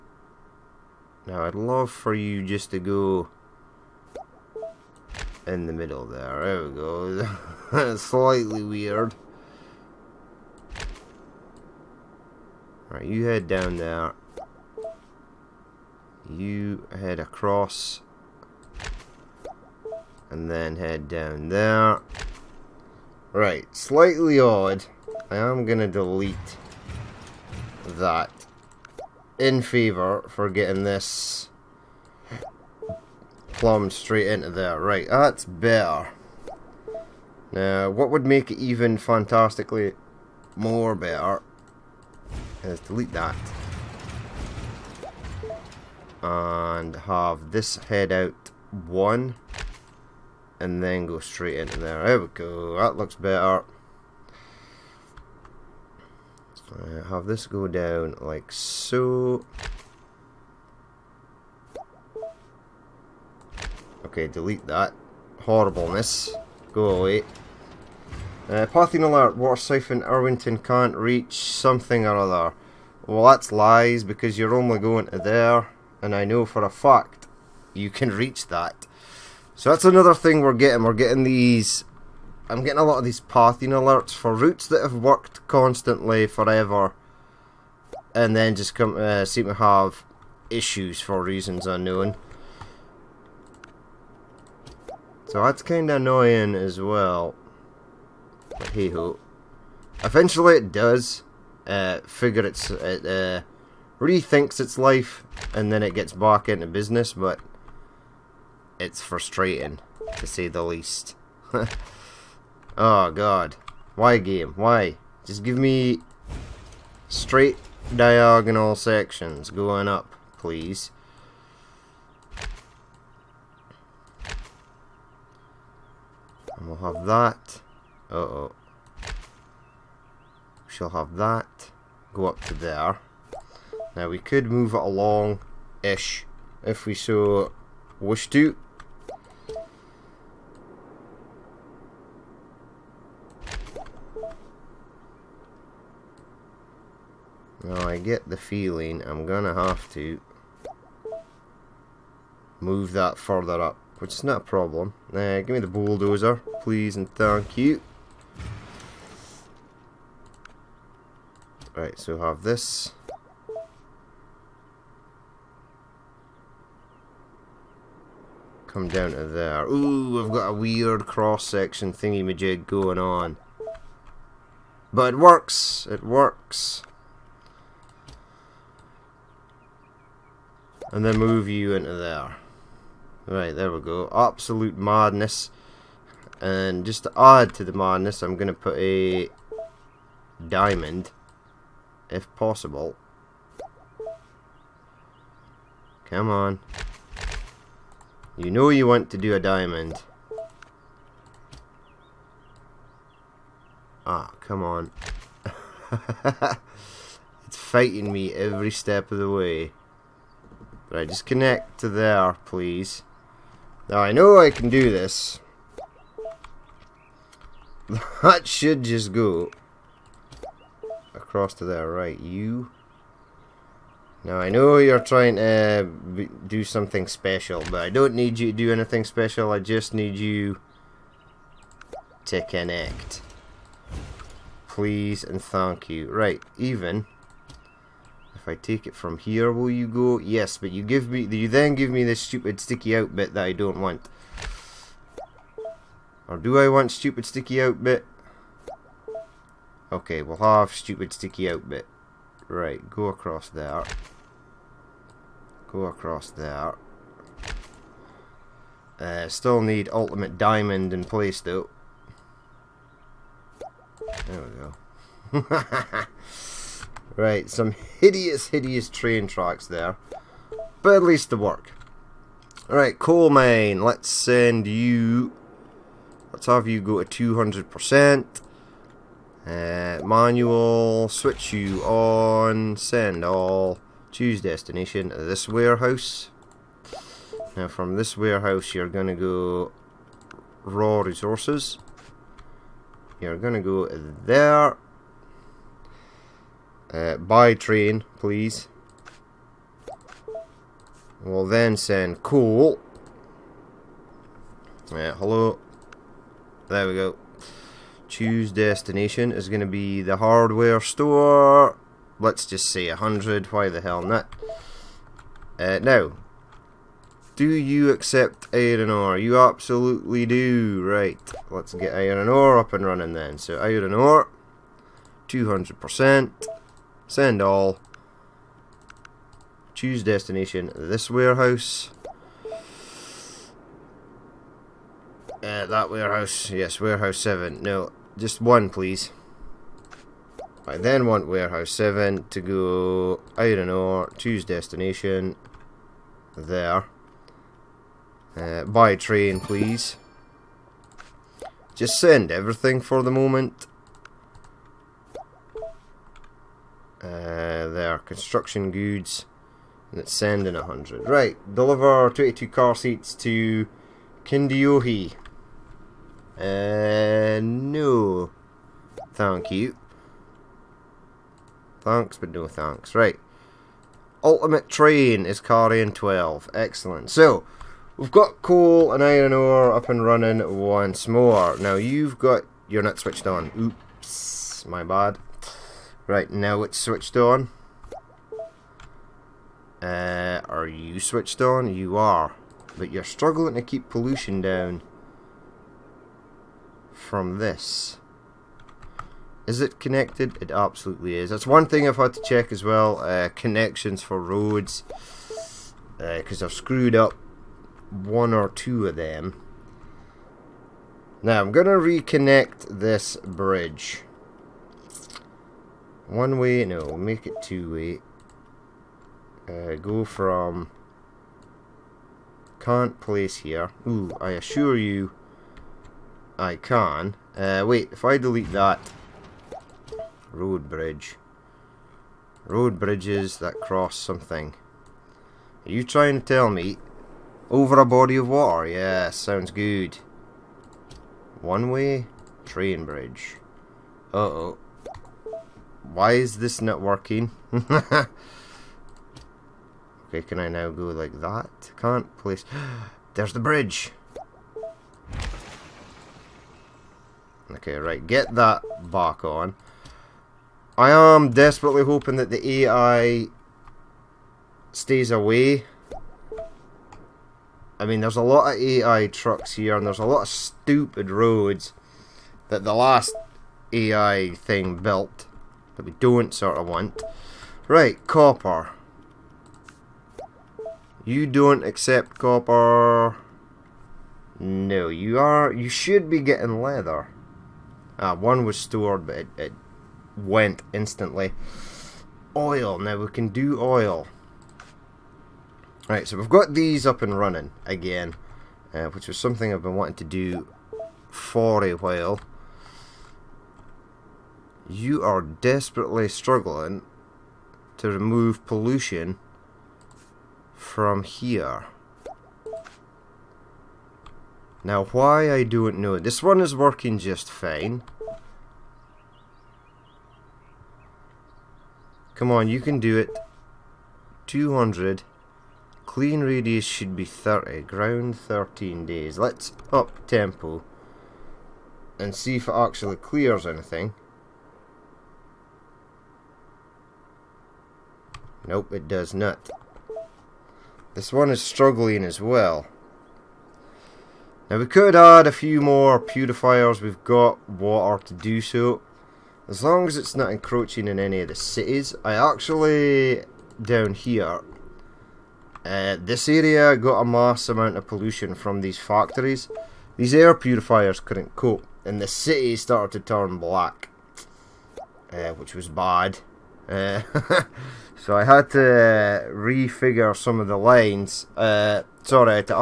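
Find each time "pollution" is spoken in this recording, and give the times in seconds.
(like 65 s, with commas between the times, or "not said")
393 s, 508 s, 557 s.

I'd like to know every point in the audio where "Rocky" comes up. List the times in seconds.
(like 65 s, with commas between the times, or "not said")
not said.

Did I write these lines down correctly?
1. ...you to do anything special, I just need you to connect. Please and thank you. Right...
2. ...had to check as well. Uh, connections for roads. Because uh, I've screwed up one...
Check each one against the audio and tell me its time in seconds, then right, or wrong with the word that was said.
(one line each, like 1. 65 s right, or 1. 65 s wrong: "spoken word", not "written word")
1. 228 s right
2. 401 s right.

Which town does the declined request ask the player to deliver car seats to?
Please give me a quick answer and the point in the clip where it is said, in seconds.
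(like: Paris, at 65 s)
Kindiohi, at 364 s.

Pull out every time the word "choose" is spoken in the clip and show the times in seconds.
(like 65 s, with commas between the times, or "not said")
284 s, 308 s, 329 s, 344 s.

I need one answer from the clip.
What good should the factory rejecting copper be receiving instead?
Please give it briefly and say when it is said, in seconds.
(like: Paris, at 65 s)
Leather, at 486 s.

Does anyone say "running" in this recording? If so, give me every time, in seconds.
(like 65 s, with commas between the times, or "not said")
322 s, 380 s, 497 s.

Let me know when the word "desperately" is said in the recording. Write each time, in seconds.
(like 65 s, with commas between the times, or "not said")
461 s, 505 s.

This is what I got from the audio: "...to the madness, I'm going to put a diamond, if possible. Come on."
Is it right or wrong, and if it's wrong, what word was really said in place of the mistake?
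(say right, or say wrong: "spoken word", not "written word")
right.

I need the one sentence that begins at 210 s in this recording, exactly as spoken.
Right, just connect to there, please.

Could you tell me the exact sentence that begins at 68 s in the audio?
Uh, alert, water siphon, Irwinton can't reach something or other.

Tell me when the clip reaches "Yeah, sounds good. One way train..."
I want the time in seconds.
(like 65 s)
438 s.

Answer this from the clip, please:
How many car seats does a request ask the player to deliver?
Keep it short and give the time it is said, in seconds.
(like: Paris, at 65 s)
22, at 362 s.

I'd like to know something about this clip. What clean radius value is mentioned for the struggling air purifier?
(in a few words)
30.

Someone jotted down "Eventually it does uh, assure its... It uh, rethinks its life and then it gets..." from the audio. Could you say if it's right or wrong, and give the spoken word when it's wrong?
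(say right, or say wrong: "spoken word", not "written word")
wrong: "figure", not "assure".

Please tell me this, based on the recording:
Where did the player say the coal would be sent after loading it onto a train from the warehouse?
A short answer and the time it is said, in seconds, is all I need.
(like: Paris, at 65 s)
Hardware store, at 310 s.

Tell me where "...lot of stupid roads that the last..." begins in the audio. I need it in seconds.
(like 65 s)
470 s.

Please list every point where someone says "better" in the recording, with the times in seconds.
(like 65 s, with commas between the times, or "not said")
35 s, 40 s, 53 s.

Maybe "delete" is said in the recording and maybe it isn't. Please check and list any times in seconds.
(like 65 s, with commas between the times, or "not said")
25 s, 42 s, 64 s, 428 s.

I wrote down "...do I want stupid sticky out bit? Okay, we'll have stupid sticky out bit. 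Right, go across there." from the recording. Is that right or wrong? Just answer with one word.
right.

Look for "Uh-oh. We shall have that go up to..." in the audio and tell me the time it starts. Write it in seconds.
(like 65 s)
128 s.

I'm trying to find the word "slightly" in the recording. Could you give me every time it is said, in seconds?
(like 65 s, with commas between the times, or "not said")
8 s, 23 s.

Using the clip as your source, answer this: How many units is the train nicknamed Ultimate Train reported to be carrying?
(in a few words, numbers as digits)
12.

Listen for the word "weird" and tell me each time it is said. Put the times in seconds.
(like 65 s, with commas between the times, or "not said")
8 s, 170 s.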